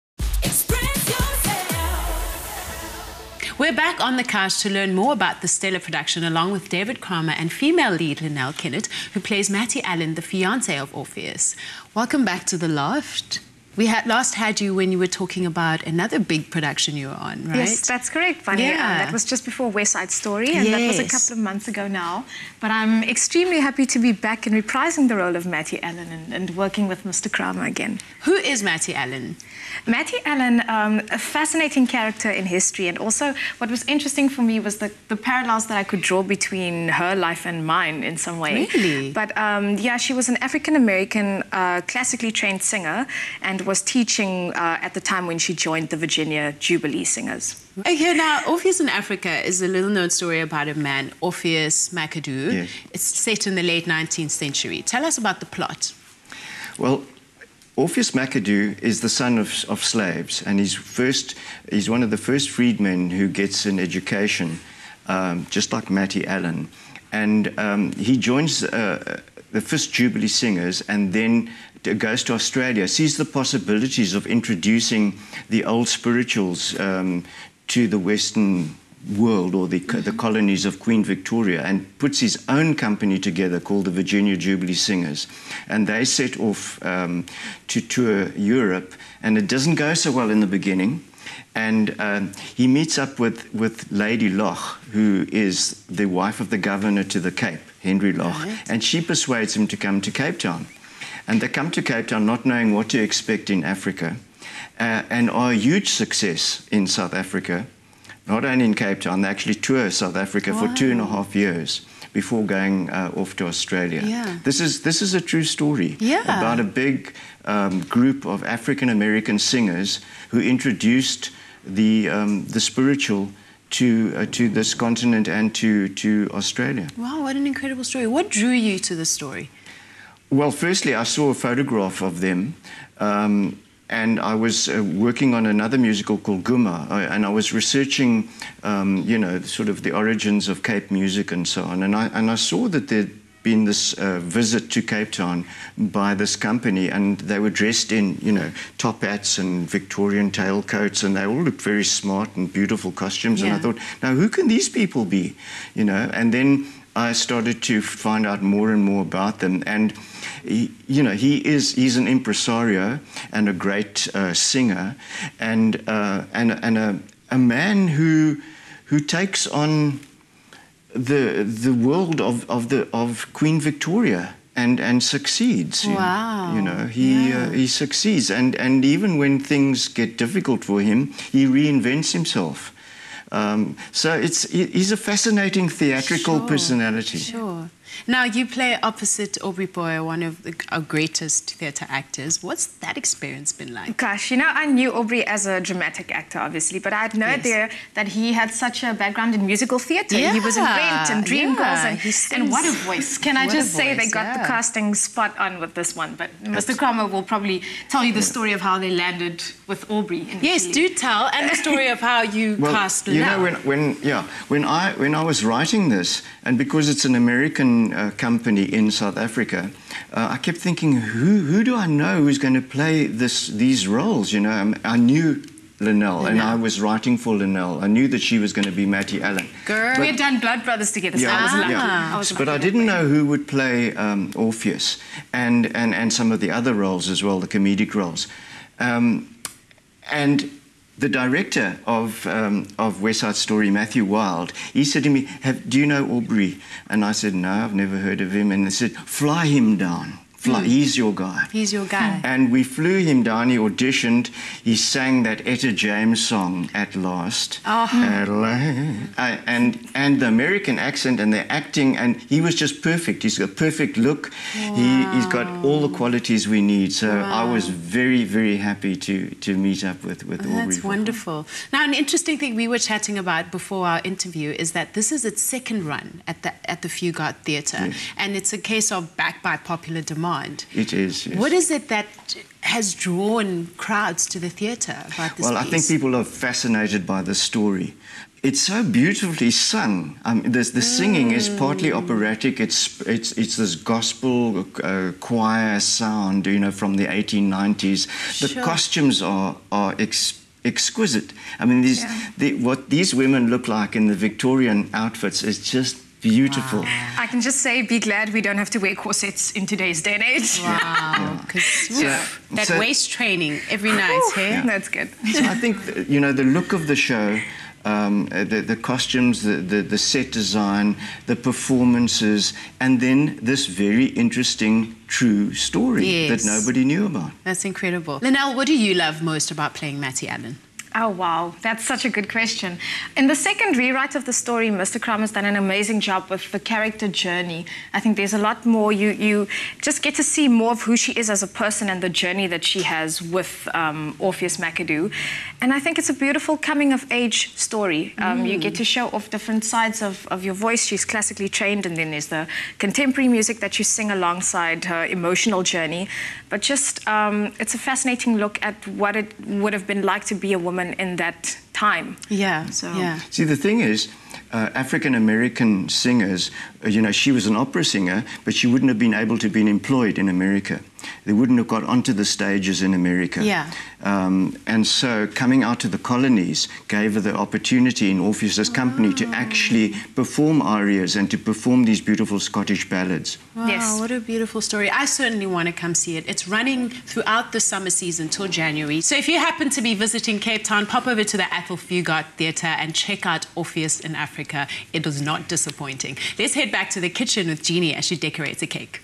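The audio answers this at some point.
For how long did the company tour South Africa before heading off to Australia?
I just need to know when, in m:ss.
1:50.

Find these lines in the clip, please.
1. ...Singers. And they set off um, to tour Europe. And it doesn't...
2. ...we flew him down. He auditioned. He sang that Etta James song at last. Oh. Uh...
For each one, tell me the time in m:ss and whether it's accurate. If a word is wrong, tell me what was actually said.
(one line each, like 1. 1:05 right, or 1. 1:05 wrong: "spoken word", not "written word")
1. 1:24 right
2. 4:12 right.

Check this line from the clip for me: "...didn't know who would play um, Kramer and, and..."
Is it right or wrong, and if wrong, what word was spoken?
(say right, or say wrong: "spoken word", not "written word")
wrong: "Orpheus", not "Kramer".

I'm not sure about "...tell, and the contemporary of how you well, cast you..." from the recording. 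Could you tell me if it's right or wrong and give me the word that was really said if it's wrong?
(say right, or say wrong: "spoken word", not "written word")
wrong: "story", not "contemporary".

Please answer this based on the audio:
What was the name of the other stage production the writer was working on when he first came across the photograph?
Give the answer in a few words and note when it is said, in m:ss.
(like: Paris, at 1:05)
Ghoema, at 2:16.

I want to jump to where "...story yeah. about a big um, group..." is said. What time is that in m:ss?
1:55.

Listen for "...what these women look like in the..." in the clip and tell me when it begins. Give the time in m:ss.
5:02.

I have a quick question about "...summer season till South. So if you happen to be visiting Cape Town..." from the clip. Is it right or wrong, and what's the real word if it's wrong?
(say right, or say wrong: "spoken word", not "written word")
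wrong: "January", not "South".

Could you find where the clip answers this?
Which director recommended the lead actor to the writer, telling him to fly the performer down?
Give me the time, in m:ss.
4:03.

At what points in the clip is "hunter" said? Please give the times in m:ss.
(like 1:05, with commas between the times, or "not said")
not said.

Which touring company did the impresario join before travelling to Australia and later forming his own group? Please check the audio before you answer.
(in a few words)
Fisk Jubilee Singers.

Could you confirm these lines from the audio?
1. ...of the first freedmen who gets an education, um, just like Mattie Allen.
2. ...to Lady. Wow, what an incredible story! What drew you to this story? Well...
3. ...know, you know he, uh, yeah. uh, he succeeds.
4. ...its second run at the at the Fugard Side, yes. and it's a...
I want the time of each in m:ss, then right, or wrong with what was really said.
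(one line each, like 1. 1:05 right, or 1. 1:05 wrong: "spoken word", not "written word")
1. 1:02 right
2. 2:05 wrong: "Australia", not "Lady"
3. 2:56 right
4. 4:35 wrong: "Theatre", not "Side".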